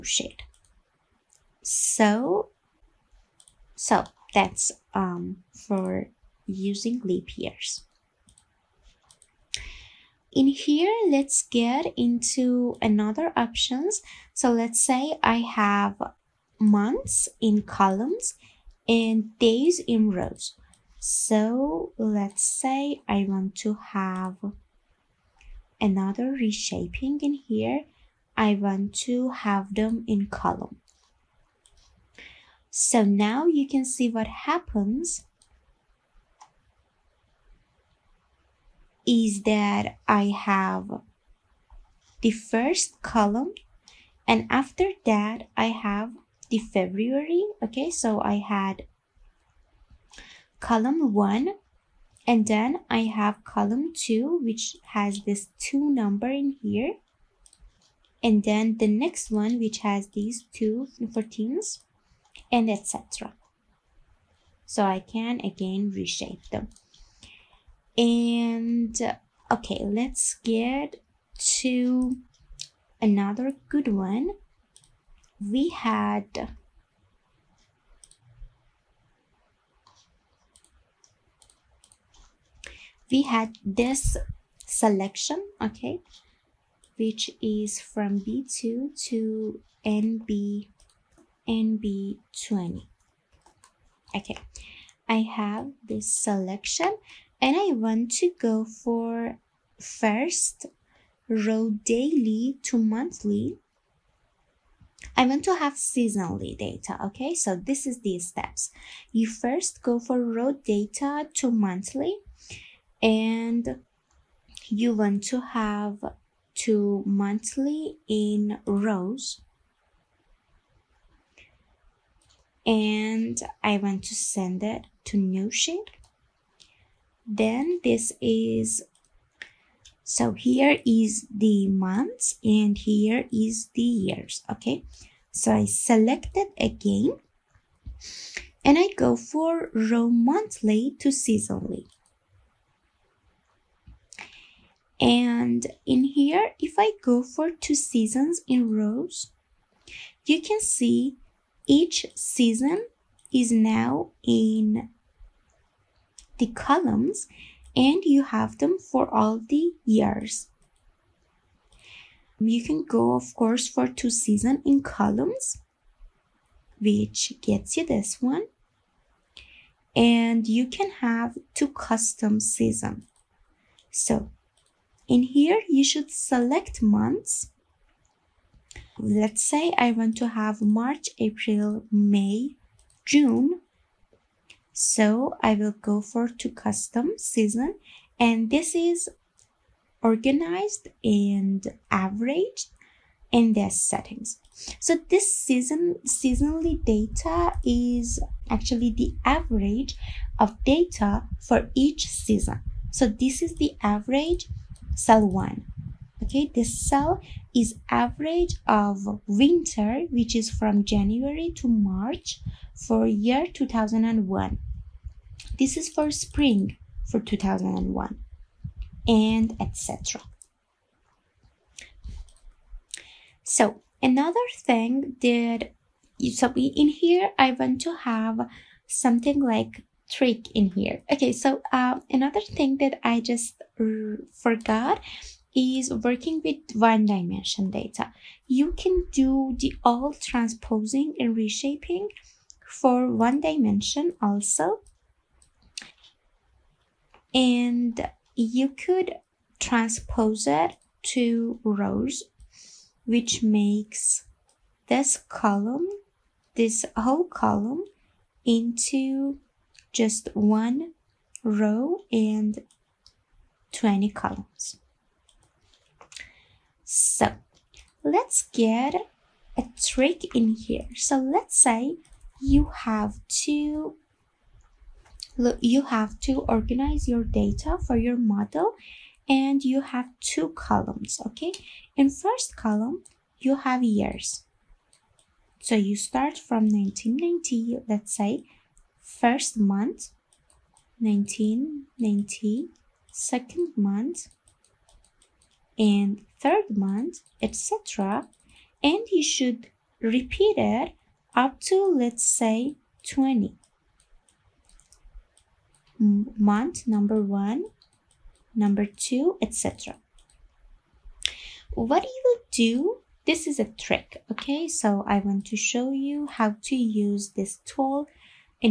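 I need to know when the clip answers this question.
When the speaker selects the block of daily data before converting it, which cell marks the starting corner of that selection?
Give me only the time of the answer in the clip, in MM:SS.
01:28.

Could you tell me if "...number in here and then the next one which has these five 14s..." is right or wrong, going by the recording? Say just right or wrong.
wrong.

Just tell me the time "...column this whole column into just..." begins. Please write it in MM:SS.
04:15.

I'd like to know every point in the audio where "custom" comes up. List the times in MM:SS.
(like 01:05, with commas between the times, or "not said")
02:51, 03:06.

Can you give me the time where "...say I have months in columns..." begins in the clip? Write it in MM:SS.
00:14.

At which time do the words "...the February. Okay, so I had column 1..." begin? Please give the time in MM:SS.
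00:46.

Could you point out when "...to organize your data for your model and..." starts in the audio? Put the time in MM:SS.
04:36.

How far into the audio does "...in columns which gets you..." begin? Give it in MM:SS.
02:44.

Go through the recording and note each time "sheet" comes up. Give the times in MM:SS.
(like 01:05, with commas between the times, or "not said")
00:00, 02:05.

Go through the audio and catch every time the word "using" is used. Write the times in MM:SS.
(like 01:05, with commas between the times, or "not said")
00:06.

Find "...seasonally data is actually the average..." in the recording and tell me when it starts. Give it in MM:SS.
03:16.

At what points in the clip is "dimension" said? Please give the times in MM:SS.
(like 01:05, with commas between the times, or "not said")
03:57, 04:03.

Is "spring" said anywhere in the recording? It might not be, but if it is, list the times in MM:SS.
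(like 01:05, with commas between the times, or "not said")
03:36.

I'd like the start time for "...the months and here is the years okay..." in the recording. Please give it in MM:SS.
02:11.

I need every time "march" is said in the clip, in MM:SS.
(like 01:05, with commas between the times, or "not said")
03:00, 03:31.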